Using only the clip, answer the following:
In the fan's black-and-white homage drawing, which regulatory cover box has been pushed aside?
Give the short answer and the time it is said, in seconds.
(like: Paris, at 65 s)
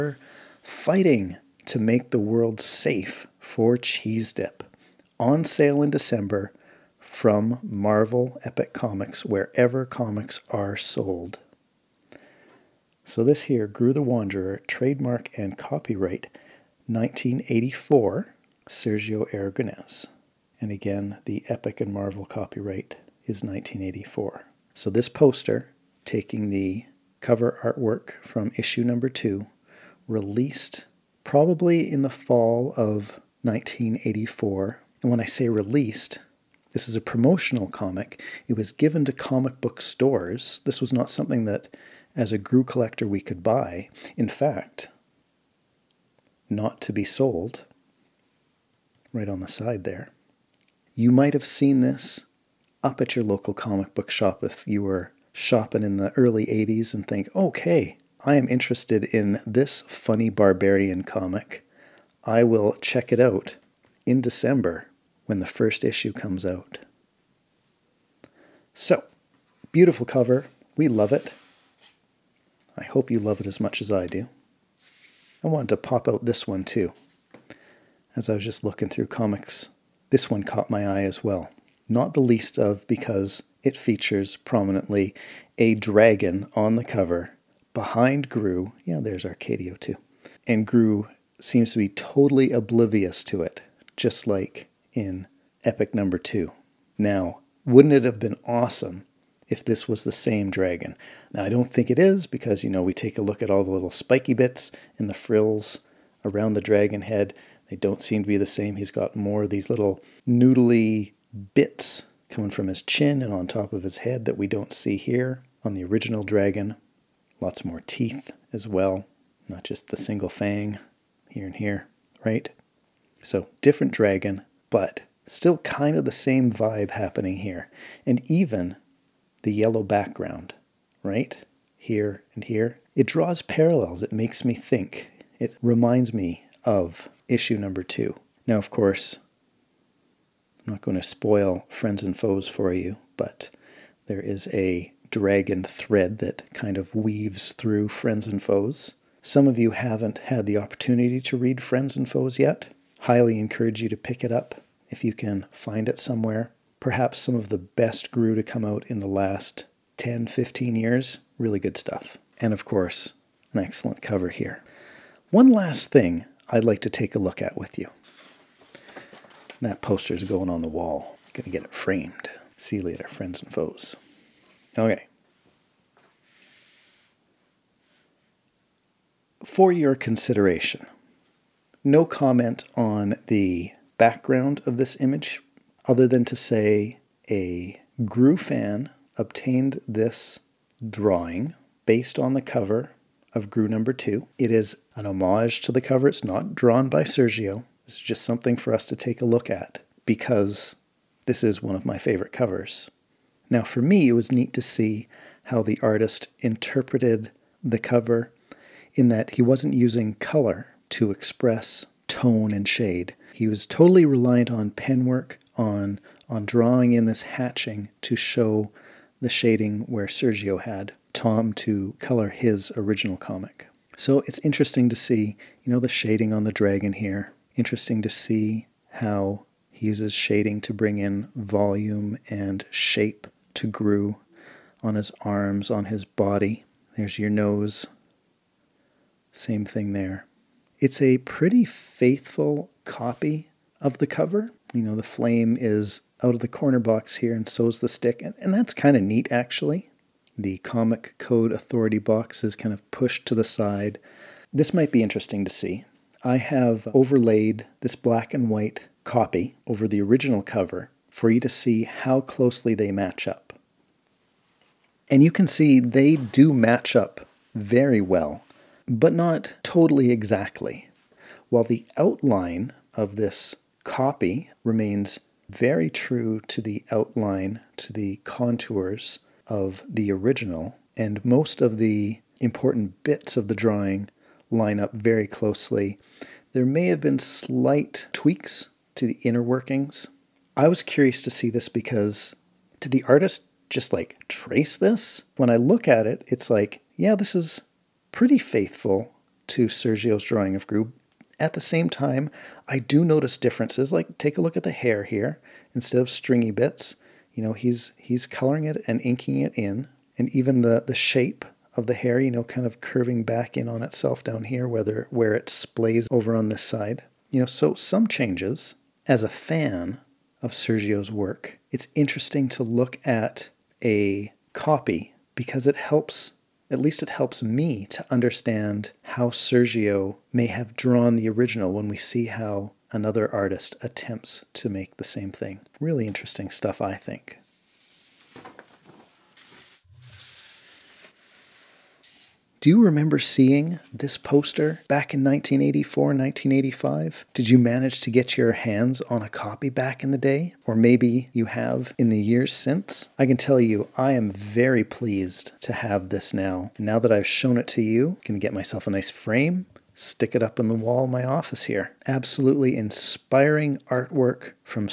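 Comic Code Authority, at 250 s.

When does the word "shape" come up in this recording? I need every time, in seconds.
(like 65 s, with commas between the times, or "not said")
232 s, 310 s.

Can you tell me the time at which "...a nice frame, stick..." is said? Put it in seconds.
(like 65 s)
358 s.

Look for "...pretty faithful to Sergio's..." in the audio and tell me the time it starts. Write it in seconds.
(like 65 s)
298 s.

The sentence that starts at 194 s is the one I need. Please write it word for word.
It is an homage to the cover.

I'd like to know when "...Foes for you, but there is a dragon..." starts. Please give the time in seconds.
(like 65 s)
142 s.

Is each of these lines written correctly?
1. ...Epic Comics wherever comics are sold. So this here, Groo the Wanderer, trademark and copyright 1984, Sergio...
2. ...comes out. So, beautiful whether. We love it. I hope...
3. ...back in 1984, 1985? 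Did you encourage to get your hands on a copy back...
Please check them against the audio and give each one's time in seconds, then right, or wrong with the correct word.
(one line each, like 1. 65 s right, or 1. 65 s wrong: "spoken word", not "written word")
1. 8 s right
2. 66 s wrong: "cover", not "whether"
3. 344 s wrong: "manage", not "encourage".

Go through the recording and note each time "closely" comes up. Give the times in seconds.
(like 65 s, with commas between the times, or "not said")
262 s, 285 s.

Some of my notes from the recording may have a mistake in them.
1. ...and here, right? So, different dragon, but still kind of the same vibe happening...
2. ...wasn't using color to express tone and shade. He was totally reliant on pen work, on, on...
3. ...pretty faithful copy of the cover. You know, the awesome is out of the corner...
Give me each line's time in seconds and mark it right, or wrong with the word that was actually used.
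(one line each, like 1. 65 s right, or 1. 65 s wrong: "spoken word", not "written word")
1. 121 s right
2. 209 s right
3. 241 s wrong: "flame", not "awesome".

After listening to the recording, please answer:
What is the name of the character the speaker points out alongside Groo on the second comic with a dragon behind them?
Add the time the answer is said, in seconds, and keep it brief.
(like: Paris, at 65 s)
Arcadio, at 89 s.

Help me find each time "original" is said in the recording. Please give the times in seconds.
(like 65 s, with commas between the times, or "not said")
115 s, 222 s, 260 s, 280 s, 331 s.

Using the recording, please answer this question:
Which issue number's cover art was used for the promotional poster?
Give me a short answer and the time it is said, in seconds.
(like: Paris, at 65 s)
2, at 28 s.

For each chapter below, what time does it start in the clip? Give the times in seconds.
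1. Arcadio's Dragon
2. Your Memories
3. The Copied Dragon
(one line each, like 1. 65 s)
1. 74 s
2. 339 s
3. 174 s.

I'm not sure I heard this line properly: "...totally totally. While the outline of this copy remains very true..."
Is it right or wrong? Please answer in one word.
wrong.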